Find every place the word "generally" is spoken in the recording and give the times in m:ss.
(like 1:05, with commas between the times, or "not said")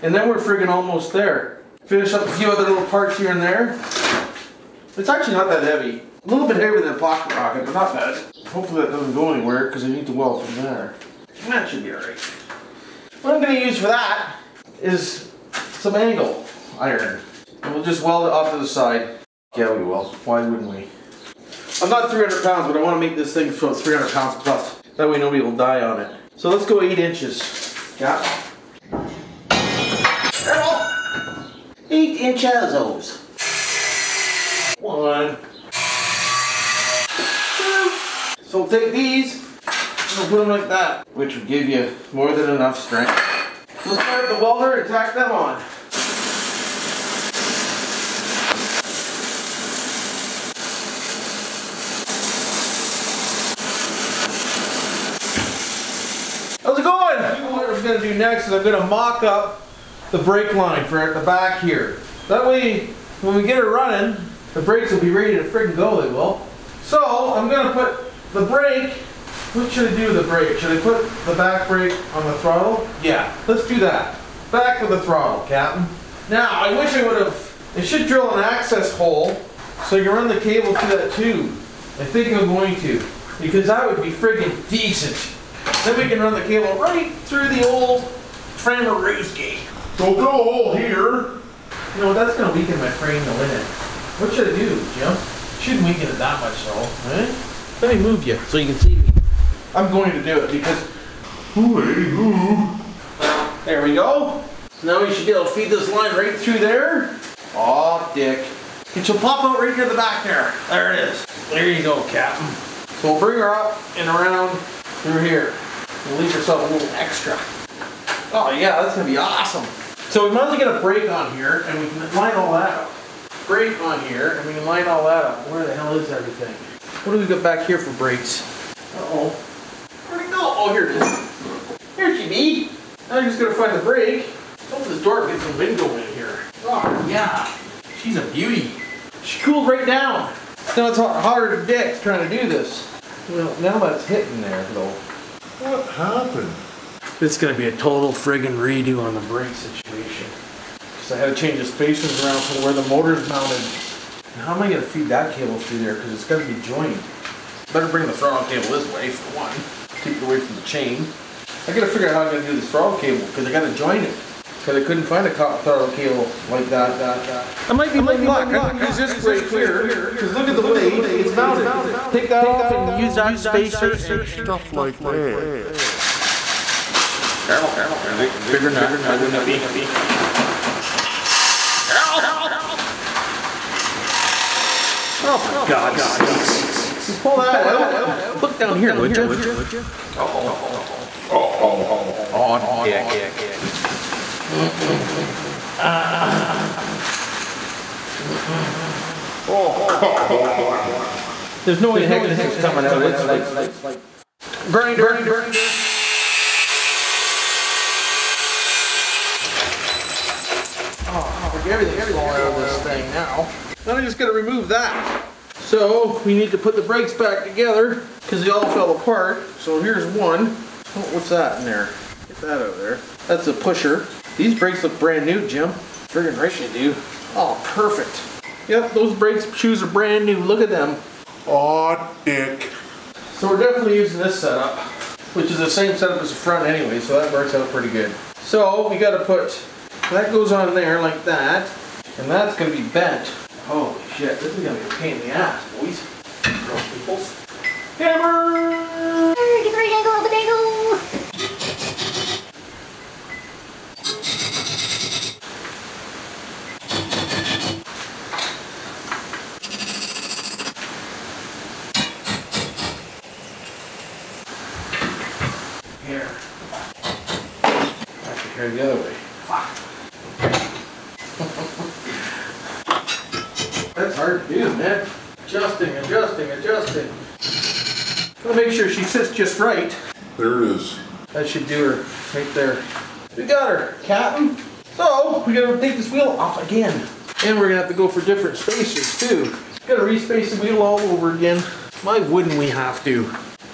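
not said.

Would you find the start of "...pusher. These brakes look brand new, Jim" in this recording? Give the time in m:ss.
3:43.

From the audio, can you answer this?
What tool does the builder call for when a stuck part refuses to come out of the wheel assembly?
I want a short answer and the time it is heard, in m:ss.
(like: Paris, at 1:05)
Grinder, at 3:24.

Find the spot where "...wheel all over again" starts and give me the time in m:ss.
4:50.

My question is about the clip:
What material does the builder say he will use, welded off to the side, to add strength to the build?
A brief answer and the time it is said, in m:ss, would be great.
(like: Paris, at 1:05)
Angle iron, at 0:15.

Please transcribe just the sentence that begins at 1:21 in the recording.
I think I'm going to, because that would be friggin' decent.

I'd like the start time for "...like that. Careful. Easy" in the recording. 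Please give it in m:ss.
2:54.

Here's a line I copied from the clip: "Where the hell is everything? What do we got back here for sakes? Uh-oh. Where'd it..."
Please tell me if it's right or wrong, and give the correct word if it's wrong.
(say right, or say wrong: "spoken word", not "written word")
wrong: "brakes", not "sakes".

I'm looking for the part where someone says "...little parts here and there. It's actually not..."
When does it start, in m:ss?
0:02.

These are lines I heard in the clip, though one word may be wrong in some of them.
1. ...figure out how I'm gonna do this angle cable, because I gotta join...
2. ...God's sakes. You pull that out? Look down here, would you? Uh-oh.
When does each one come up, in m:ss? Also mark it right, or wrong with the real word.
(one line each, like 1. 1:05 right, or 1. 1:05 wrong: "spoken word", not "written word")
1. 2:41 wrong: "throttle", not "angle"
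2. 3:05 right.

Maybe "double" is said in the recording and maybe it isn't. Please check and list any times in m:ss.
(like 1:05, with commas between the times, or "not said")
not said.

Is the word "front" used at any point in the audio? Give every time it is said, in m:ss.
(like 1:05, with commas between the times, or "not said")
3:56.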